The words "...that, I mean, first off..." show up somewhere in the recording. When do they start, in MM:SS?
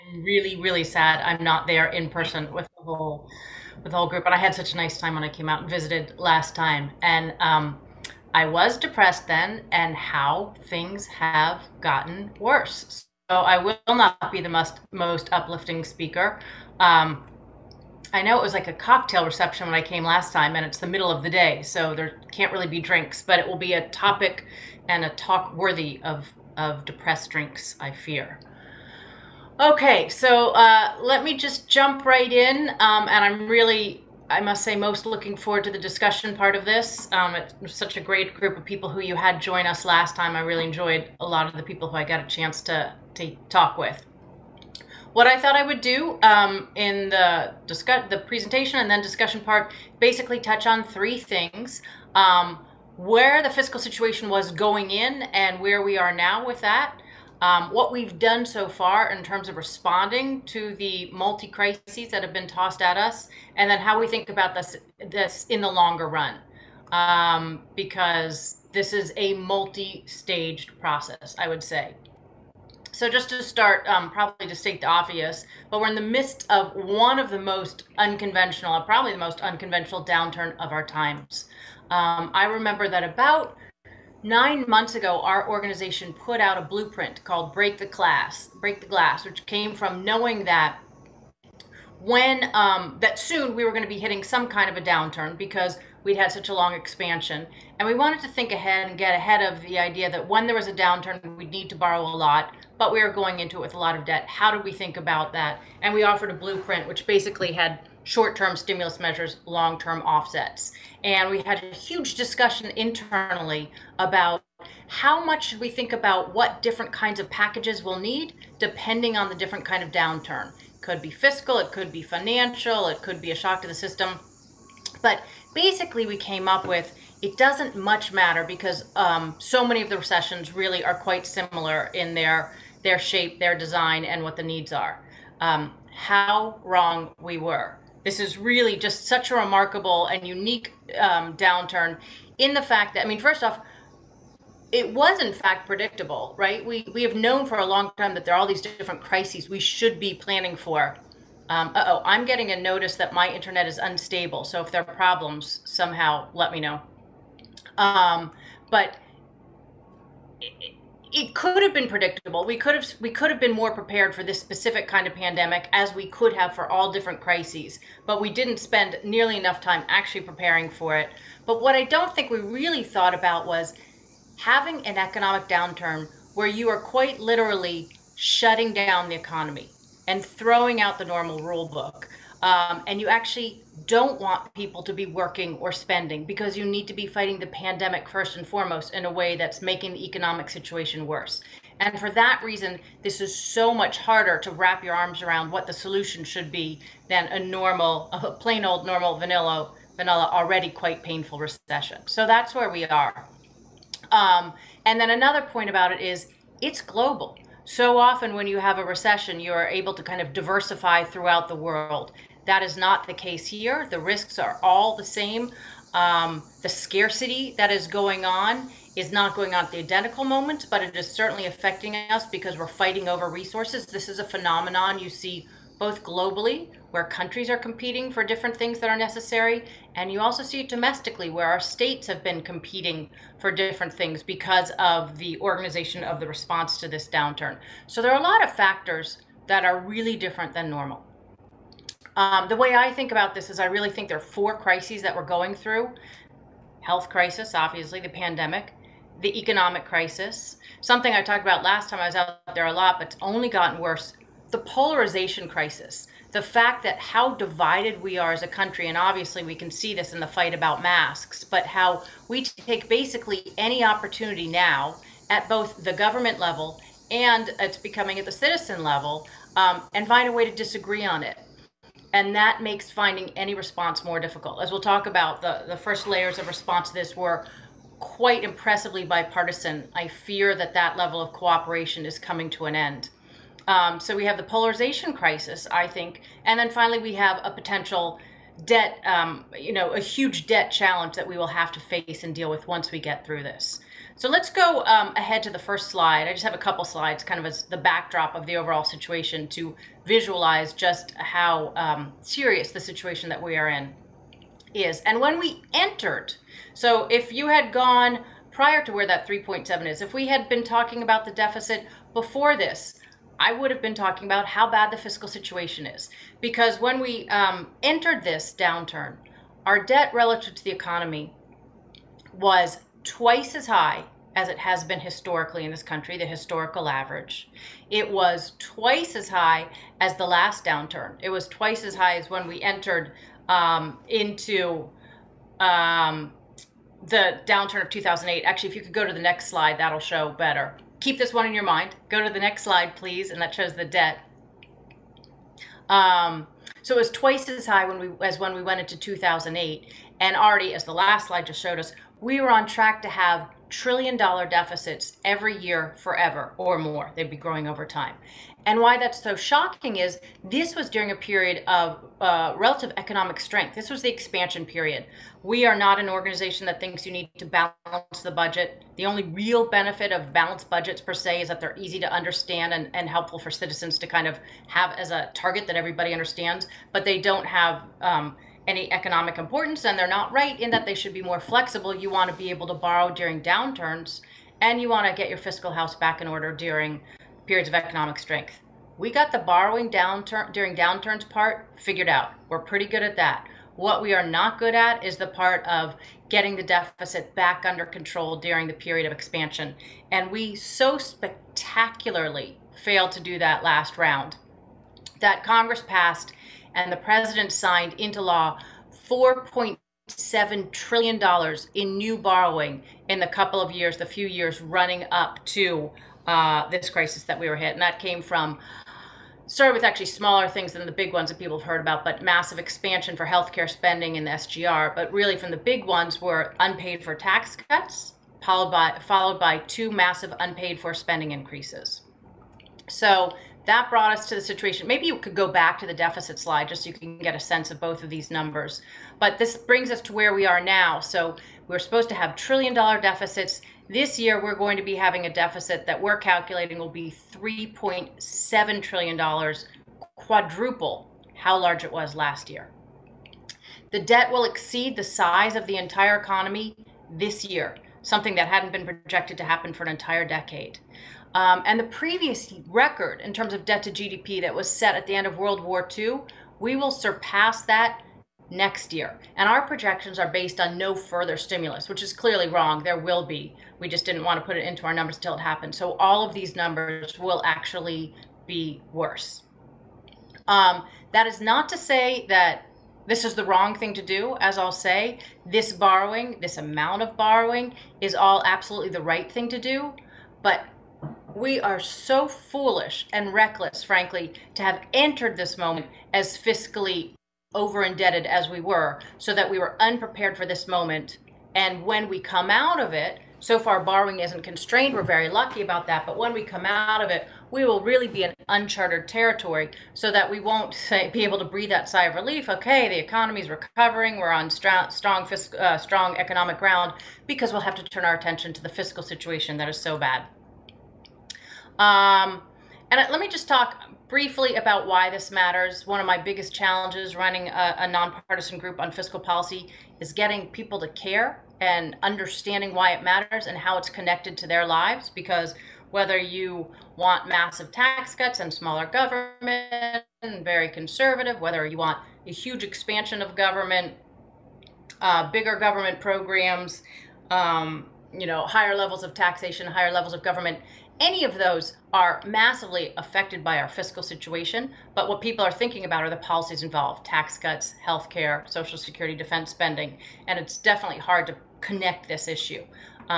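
02:22.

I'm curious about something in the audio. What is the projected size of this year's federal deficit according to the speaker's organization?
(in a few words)
$3.7 trillion.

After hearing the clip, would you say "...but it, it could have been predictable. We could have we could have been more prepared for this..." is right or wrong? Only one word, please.
right.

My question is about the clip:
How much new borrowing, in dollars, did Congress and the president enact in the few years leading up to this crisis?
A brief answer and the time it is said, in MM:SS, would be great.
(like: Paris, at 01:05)
$4.7 trillion, at 06:49.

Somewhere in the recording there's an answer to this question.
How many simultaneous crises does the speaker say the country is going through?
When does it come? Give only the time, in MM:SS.
04:04.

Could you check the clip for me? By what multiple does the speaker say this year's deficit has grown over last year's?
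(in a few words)
quadruple.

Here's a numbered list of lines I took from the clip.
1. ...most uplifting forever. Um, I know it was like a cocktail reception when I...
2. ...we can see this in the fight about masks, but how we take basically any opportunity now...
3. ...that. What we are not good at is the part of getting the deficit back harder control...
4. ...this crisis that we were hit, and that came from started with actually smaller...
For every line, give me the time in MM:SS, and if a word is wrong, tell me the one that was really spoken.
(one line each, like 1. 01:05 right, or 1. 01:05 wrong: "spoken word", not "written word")
1. 00:14 wrong: "speaker", not "forever"
2. 04:19 right
3. 06:33 wrong: "under", not "harder"
4. 06:56 right.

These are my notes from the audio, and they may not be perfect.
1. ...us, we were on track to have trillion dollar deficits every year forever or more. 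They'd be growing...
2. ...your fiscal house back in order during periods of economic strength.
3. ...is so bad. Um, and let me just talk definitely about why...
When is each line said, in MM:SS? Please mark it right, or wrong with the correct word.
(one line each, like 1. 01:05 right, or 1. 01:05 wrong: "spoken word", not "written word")
1. 05:51 right
2. 06:25 right
3. 08:39 wrong: "briefly", not "definitely".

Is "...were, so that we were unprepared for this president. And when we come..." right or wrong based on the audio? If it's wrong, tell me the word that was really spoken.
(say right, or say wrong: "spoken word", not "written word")
wrong: "moment", not "president".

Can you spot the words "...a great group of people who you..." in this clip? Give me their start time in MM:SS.
00:37.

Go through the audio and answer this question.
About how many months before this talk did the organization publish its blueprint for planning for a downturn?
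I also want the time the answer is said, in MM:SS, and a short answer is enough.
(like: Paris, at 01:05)
9, at 01:24.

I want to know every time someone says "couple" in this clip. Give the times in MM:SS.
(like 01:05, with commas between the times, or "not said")
04:56, 06:53.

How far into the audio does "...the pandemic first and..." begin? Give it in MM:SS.
03:07.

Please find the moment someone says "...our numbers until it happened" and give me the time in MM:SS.
07:54.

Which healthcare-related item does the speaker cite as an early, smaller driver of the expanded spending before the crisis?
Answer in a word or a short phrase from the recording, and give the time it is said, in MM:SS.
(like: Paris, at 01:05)
SGR, at 07:04.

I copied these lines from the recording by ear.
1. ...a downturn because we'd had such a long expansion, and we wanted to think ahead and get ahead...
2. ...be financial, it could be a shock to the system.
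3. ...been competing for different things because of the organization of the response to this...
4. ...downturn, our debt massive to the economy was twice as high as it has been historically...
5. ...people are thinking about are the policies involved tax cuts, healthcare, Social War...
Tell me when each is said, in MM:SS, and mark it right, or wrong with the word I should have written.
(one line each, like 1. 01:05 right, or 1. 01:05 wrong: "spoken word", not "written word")
1. 01:34 right
2. 02:01 right
3. 03:52 right
4. 05:18 wrong: "relative", not "massive"
5. 09:15 wrong: "Security", not "War".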